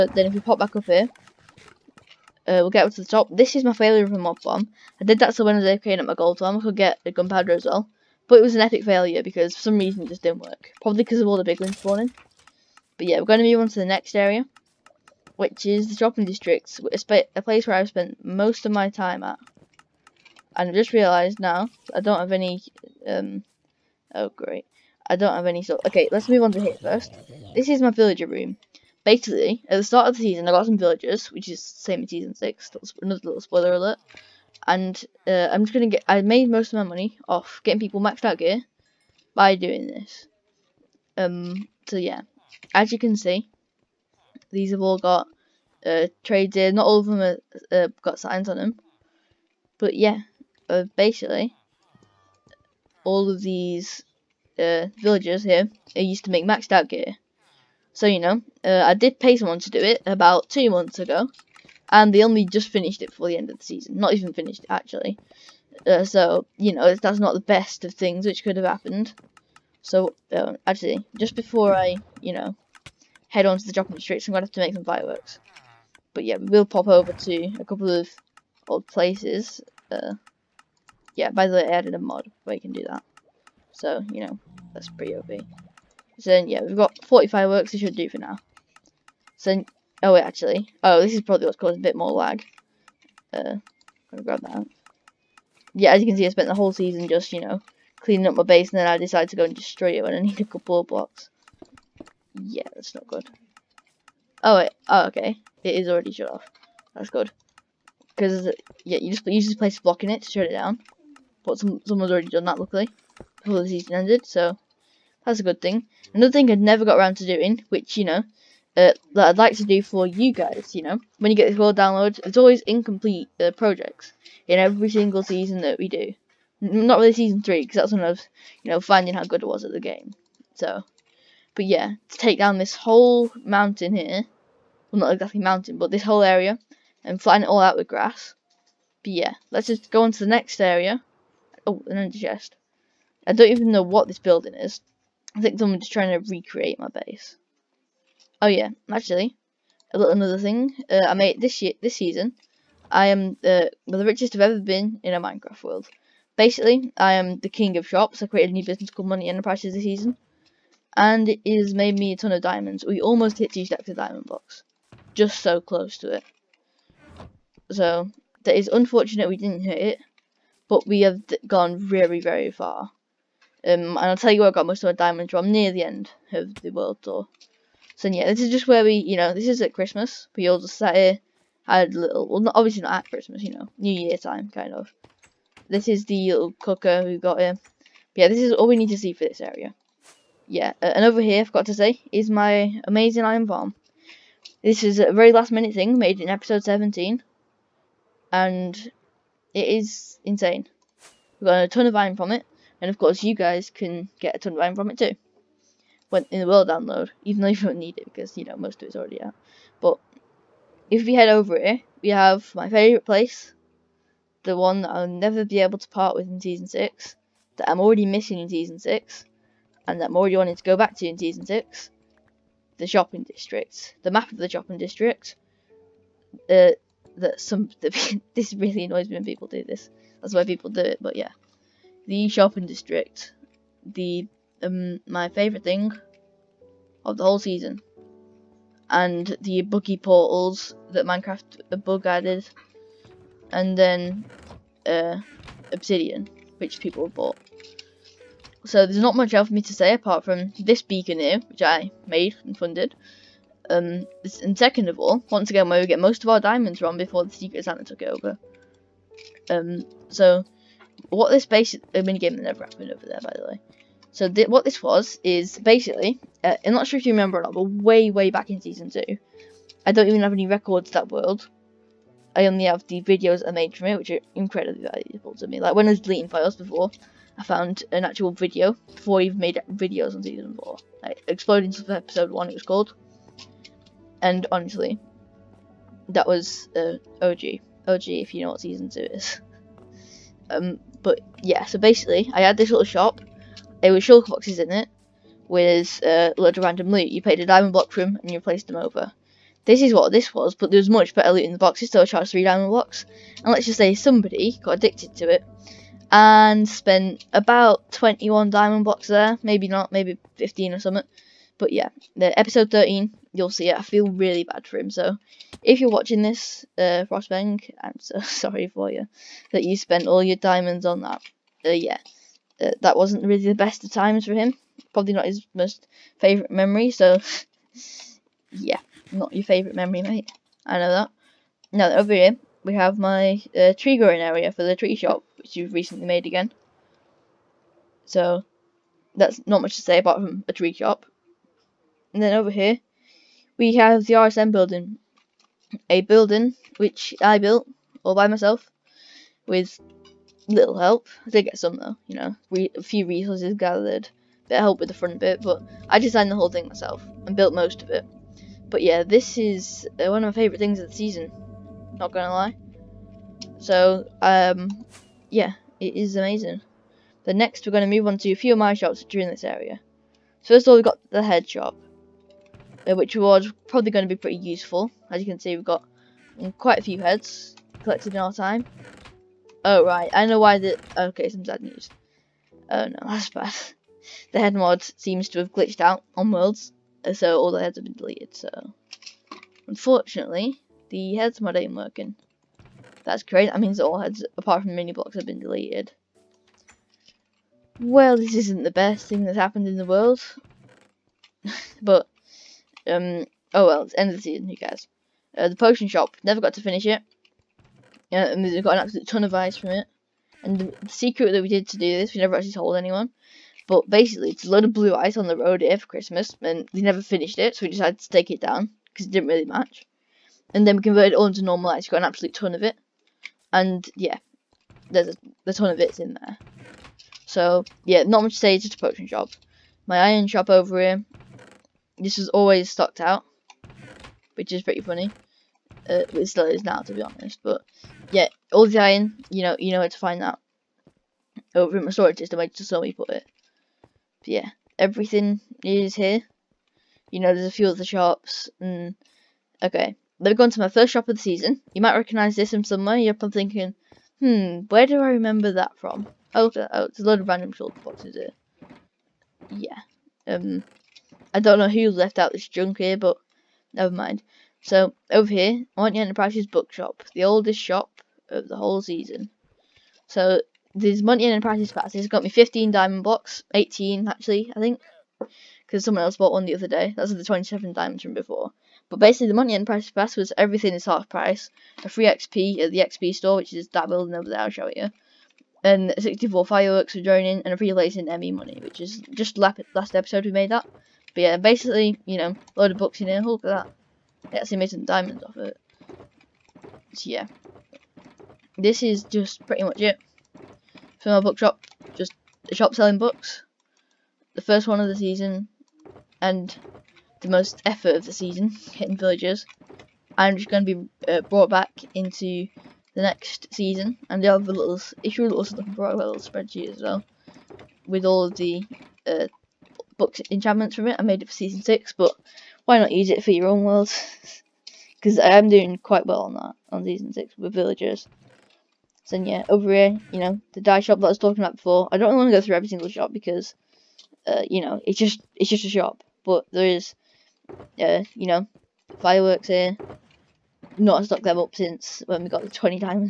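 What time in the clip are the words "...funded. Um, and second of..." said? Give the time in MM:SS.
04:12.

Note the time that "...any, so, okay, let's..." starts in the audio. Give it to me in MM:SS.
00:25.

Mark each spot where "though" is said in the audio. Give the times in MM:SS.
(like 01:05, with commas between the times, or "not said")
03:27, 05:51.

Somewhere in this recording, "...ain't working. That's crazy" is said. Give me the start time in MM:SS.
06:31.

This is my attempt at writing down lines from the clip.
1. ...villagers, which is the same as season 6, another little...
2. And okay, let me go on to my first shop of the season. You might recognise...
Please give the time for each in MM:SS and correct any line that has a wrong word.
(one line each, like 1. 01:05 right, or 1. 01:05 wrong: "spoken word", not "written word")
1. 00:30 right
2. 07:28 right.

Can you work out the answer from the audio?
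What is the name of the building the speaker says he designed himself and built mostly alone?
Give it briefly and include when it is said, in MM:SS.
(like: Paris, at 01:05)
RSM building, at 05:44.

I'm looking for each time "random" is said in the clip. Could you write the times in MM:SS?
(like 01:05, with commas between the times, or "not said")
04:56, 07:37.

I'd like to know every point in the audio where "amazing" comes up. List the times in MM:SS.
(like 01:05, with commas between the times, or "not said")
03:12, 06:06.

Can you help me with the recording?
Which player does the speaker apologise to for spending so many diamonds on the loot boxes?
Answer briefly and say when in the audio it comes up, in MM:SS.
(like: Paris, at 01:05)
Frostbang, at 05:17.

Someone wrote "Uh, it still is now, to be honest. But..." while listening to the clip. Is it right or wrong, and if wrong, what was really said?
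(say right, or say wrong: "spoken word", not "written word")
right.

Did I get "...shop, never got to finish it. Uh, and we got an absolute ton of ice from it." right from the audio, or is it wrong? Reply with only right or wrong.
right.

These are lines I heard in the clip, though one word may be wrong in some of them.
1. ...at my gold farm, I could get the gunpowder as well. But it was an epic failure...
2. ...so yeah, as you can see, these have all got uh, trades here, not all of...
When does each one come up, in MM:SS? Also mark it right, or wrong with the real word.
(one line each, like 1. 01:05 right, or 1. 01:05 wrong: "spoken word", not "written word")
1. 00:05 right
2. 00:41 right.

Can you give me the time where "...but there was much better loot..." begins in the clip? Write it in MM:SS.
05:00.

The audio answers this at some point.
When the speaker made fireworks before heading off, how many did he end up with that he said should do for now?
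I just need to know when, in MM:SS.
01:27.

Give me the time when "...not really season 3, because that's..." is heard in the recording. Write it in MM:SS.
02:06.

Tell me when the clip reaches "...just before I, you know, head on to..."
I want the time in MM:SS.
01:11.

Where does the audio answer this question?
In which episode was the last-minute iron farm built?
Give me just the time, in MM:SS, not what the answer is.
03:16.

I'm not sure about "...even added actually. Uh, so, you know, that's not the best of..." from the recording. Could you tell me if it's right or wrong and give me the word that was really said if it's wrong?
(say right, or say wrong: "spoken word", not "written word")
wrong: "finished", not "added".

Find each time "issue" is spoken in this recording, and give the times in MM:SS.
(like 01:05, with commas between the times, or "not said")
08:35.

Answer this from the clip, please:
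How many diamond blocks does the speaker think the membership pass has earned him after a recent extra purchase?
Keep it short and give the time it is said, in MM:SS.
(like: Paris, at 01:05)
18, at 07:53.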